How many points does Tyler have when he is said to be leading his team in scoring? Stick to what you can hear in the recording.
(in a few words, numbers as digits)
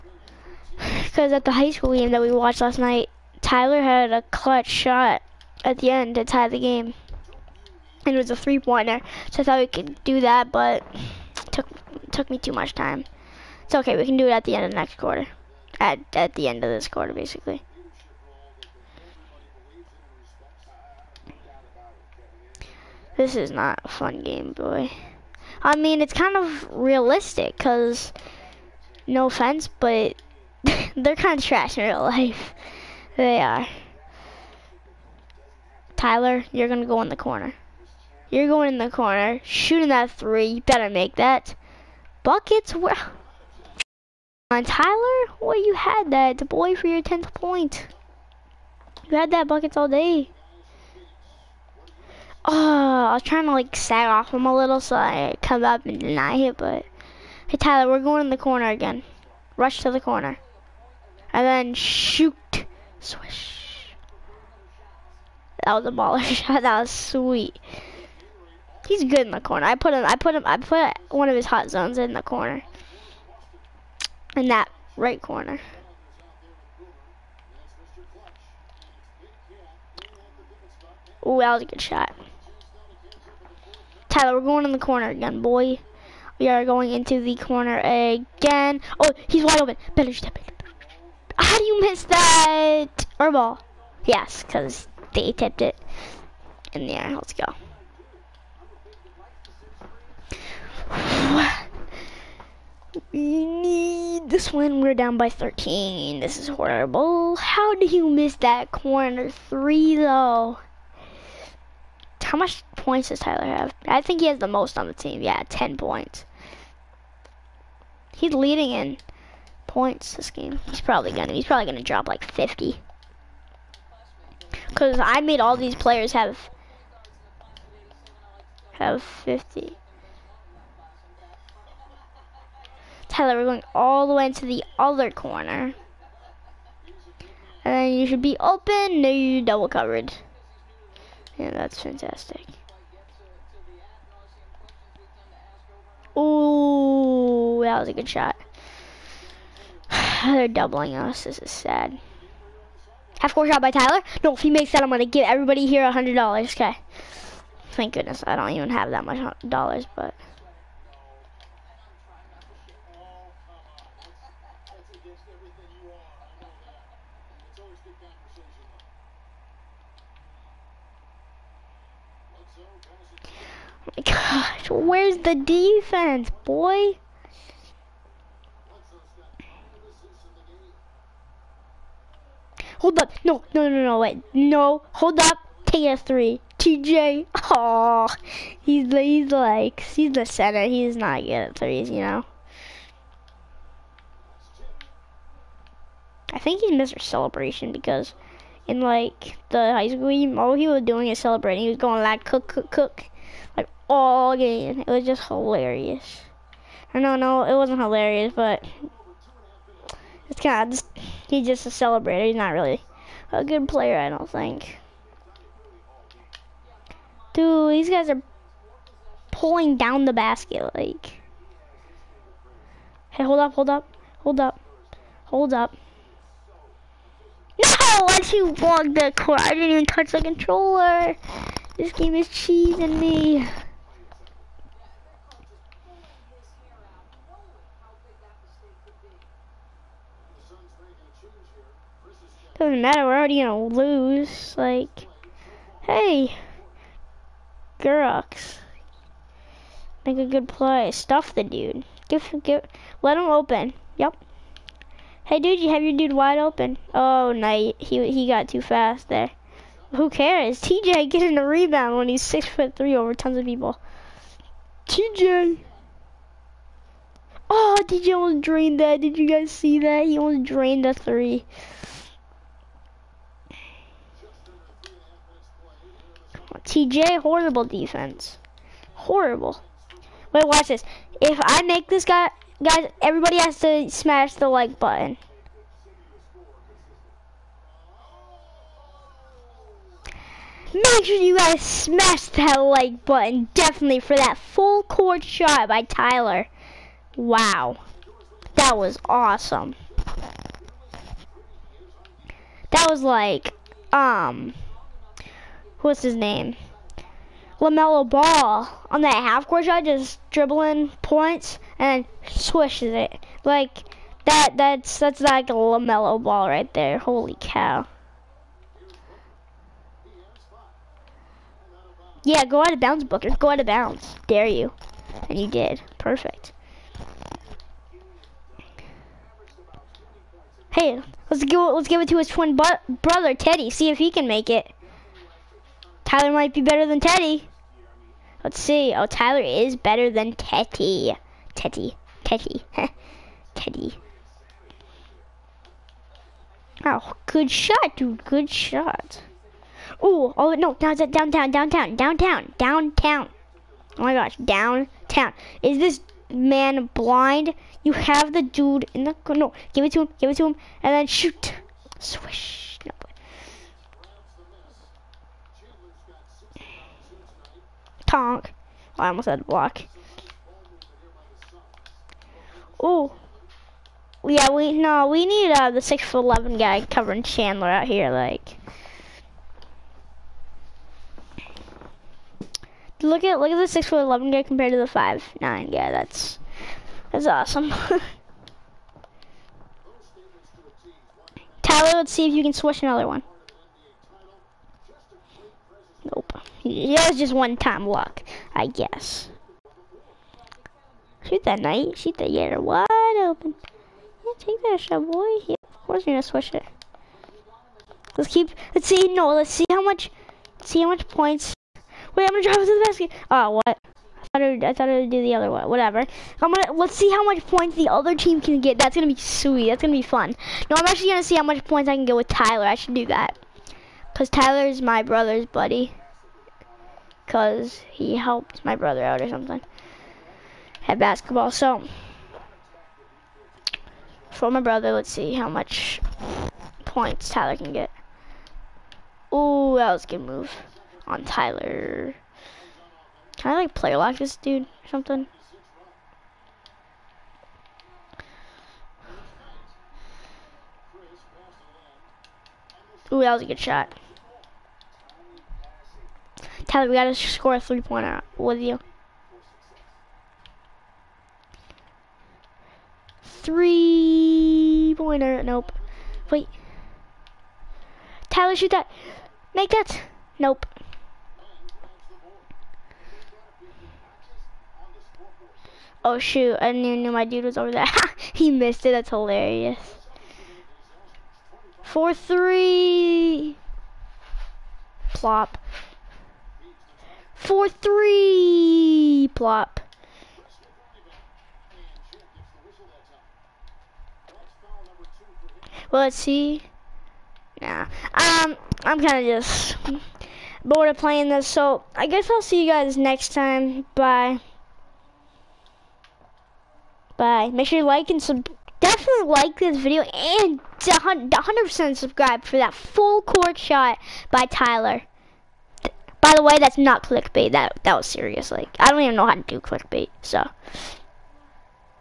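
10.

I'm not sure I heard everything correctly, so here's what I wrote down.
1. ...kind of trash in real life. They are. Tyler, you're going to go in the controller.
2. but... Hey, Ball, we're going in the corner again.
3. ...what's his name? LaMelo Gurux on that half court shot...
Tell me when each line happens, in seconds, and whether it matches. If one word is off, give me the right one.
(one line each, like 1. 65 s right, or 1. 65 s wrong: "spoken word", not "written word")
1. 31 s wrong: "corner", not "controller"
2. 56 s wrong: "Tyler", not "Ball"
3. 305 s wrong: "Ball", not "Gurux".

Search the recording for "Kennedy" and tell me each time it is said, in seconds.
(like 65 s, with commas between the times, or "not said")
not said.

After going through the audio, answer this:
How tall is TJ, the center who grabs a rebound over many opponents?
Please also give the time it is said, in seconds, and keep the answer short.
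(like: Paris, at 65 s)
six foot three, at 262 s.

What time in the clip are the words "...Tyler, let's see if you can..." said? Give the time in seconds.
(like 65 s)
391 s.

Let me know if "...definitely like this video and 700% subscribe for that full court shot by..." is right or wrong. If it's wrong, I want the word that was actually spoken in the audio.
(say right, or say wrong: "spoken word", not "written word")
wrong: "100", not "700".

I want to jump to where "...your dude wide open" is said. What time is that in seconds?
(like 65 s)
255 s.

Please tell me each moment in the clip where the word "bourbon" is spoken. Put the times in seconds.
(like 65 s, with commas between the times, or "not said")
not said.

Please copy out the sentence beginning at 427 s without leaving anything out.
Cause he helped my brother out or something at basketball.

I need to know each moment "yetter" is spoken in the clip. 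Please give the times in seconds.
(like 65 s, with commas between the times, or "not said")
402 s.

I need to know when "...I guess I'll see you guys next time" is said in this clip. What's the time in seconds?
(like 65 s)
501 s.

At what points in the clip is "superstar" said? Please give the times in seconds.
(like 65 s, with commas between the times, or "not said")
not said.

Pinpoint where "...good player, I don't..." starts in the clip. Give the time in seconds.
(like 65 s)
213 s.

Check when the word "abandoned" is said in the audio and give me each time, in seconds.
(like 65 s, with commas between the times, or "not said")
not said.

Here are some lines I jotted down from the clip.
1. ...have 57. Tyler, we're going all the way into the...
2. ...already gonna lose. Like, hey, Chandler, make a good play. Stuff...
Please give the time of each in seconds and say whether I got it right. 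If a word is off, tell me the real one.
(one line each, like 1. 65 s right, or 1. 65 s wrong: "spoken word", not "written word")
1. 128 s wrong: "50", not "57"
2. 243 s wrong: "Gurux", not "Chandler".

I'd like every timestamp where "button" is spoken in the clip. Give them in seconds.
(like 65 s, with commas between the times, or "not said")
284 s, 293 s.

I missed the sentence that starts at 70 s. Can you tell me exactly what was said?
I put one of his hot zones in the corner.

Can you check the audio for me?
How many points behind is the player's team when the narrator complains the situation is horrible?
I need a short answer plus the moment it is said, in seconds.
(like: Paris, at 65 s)
13, at 105 s.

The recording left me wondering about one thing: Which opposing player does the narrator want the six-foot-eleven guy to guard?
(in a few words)
Chandler.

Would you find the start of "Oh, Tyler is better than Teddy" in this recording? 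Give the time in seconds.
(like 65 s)
338 s.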